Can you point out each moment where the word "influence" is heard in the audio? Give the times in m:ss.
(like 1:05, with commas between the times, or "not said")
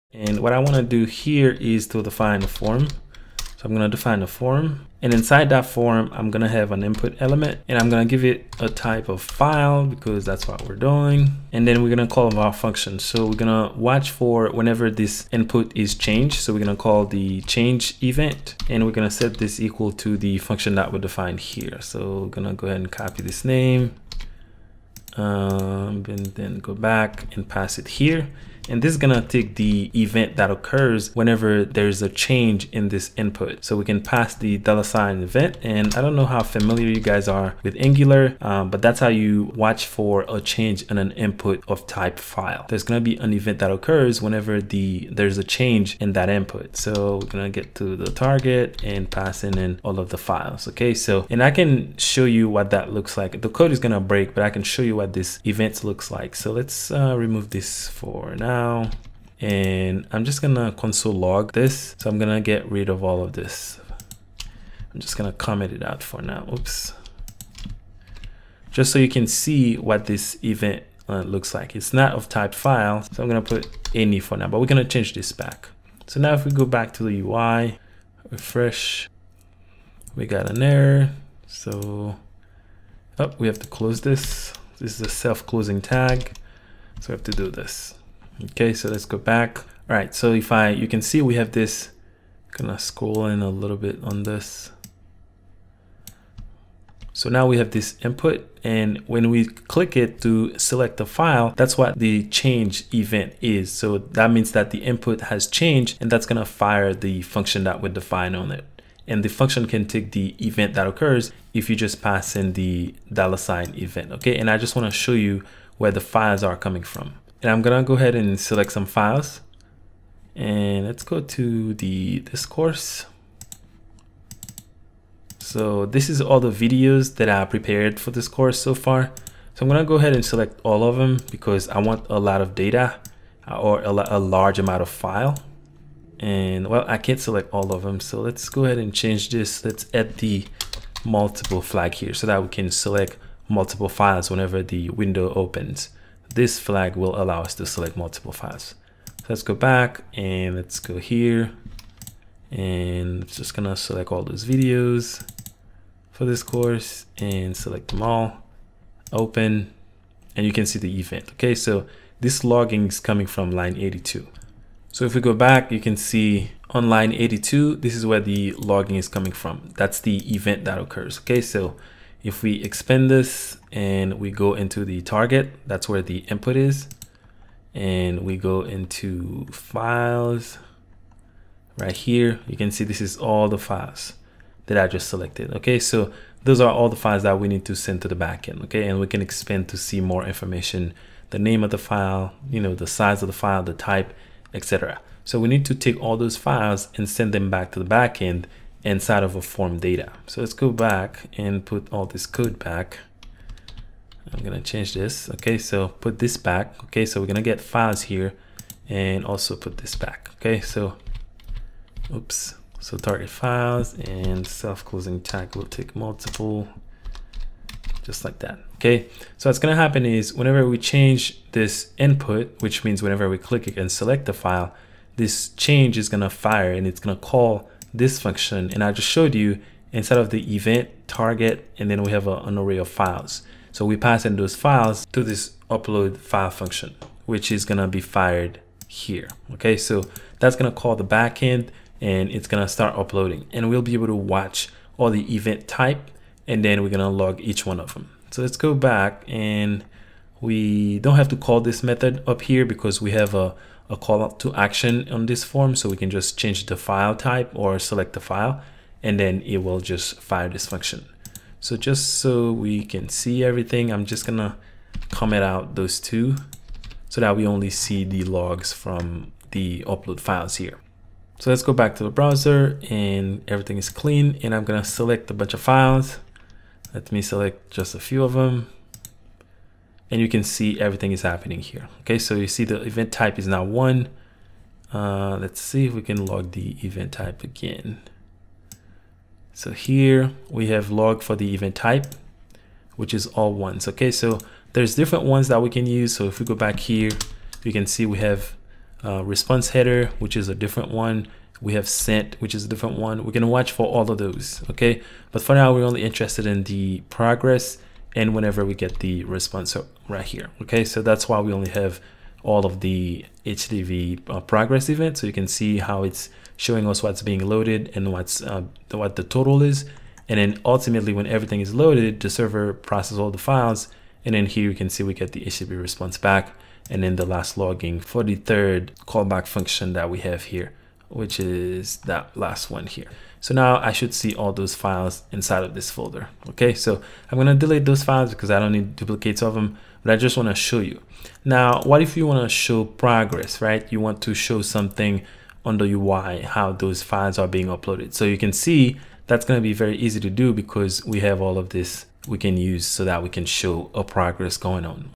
not said.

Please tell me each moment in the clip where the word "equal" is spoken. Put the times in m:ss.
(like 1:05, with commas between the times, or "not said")
0:19.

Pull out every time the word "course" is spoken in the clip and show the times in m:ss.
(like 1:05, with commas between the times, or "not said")
2:02, 2:08, 2:36.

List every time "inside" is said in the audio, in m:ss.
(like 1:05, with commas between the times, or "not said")
0:05, 3:18, 3:49, 5:35.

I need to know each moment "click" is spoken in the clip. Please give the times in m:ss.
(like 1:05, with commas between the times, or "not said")
1:39, 3:43.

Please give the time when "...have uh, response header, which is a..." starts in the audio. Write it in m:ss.
4:58.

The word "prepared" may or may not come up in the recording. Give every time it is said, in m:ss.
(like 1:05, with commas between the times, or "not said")
2:07.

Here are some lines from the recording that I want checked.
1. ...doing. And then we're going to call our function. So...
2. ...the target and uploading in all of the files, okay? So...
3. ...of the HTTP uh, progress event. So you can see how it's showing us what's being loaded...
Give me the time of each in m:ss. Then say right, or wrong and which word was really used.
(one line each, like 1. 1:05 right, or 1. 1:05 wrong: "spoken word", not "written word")
1. 0:10 right
2. 0:47 wrong: "passing", not "uploading"
3. 5:12 right.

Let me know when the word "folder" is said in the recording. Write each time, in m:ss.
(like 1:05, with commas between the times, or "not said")
5:35.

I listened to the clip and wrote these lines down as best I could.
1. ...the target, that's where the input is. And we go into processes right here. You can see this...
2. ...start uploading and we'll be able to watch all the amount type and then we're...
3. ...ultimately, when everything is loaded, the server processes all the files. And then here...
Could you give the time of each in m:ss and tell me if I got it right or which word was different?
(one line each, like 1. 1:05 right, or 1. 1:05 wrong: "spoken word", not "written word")
1. 2:54 wrong: "files", not "processes"
2. 4:02 wrong: "event", not "amount"
3. 5:20 right.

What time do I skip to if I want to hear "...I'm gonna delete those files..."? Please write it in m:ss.
5:37.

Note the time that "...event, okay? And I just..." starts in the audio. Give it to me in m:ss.
1:53.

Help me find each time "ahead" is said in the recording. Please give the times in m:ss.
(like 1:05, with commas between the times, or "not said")
0:22, 1:57, 2:09, 2:18.